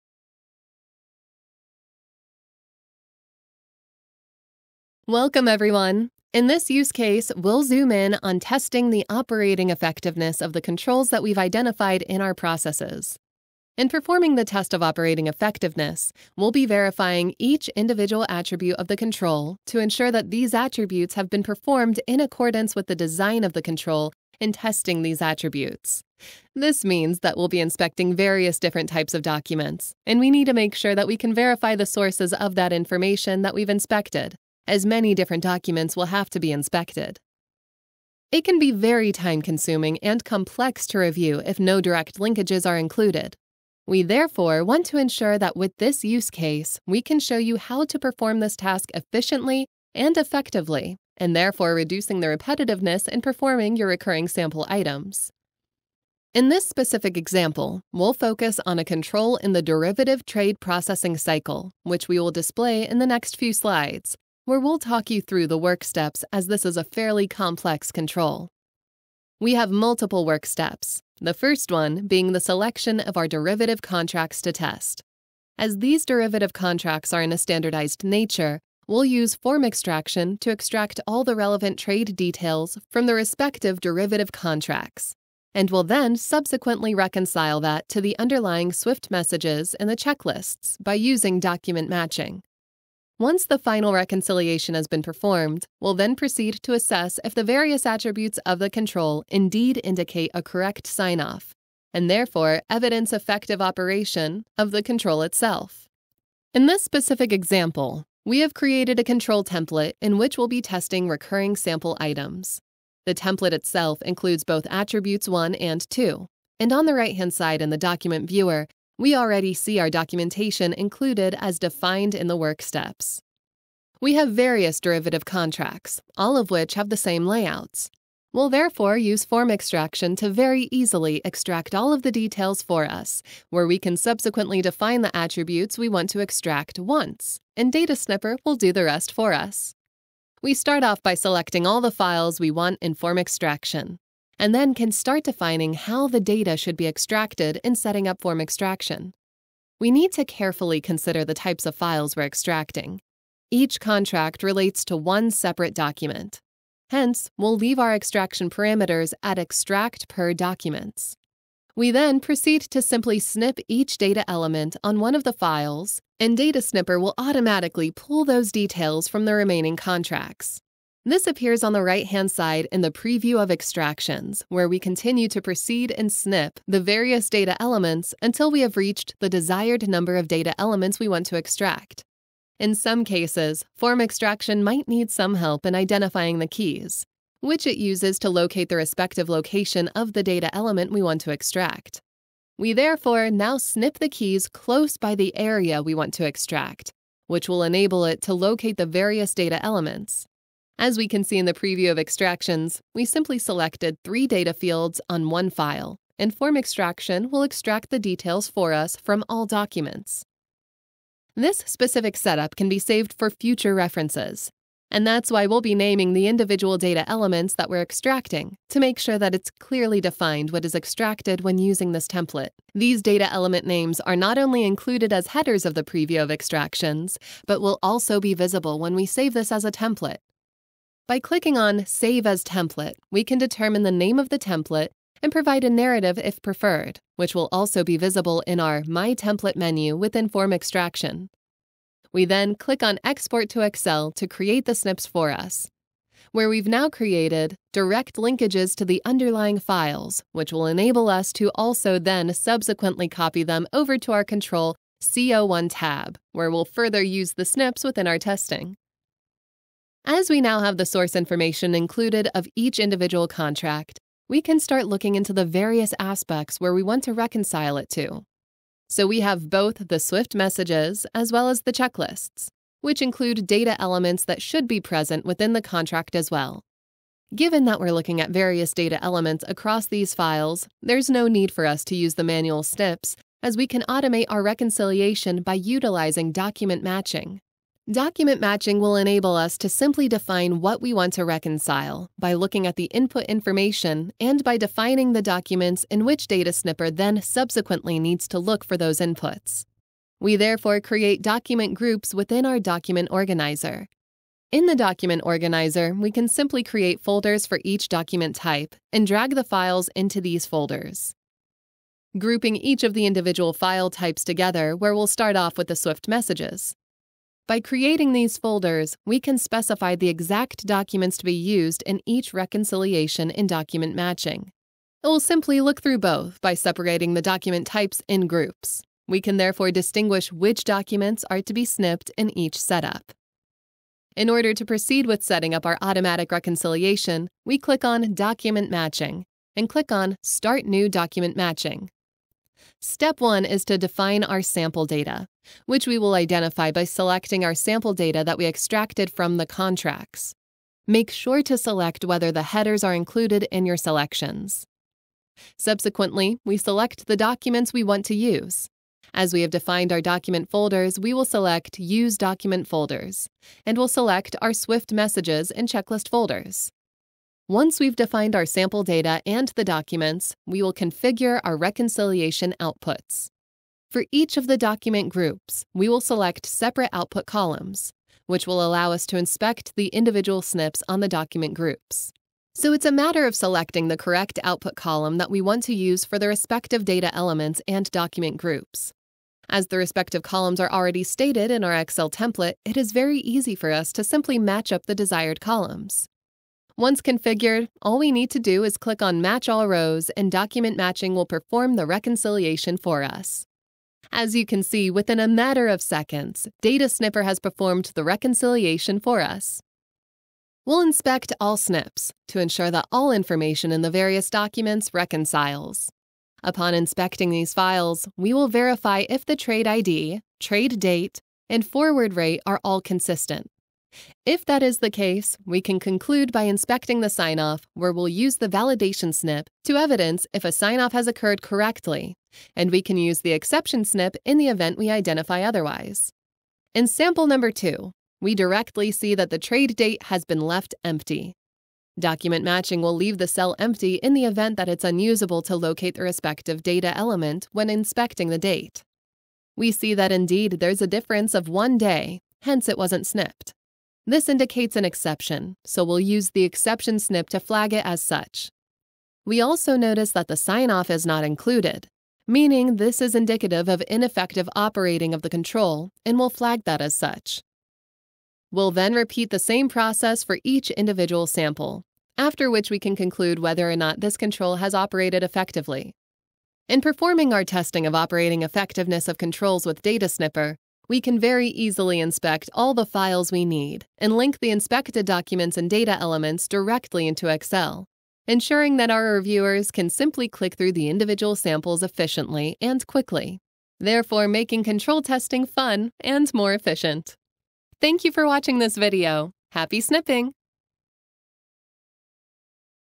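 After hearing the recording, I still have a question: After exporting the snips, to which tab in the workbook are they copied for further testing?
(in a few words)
Control CO1.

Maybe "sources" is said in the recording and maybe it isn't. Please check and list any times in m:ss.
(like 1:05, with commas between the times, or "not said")
0:31, 4:20.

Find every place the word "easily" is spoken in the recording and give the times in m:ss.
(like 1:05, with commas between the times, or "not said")
2:10, 8:01.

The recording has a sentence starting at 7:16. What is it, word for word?
In sample number 2, we directly see that the trade date has been left empty.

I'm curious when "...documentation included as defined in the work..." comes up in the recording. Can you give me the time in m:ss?
1:59.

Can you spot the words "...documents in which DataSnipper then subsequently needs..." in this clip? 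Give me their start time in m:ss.
4:55.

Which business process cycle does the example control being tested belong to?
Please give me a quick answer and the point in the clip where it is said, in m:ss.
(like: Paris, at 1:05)
Derivative trade processing, at 0:59.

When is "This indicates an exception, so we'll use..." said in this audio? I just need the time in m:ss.
7:34.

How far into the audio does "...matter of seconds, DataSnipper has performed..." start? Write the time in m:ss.
6:45.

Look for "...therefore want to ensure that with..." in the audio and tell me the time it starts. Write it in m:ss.
0:44.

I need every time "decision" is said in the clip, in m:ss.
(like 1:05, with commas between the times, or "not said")
not said.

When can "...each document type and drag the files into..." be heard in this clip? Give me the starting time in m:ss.
5:07.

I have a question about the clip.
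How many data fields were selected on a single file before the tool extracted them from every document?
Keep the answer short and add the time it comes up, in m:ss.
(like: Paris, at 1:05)
3, at 3:24.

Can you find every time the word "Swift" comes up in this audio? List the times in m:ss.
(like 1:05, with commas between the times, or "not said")
1:28, 4:29, 5:15, 6:04.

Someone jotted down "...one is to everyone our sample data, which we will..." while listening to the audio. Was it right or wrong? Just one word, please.
wrong.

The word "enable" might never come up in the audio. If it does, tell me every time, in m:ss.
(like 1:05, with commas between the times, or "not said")
3:17, 4:10, 4:48.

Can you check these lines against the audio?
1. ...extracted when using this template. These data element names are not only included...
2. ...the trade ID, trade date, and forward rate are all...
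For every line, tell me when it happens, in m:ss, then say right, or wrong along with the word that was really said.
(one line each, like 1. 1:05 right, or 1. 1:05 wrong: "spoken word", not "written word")
1. 3:40 right
2. 6:59 right.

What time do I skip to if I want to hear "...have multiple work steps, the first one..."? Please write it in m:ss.
1:09.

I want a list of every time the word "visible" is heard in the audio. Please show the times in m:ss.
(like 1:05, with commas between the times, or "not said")
3:48, 3:57.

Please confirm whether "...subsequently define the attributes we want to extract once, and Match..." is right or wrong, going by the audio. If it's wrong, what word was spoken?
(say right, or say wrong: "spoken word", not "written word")
wrong: "DataSnipper", not "Match".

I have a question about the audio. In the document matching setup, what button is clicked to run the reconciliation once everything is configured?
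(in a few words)
Match All Rows.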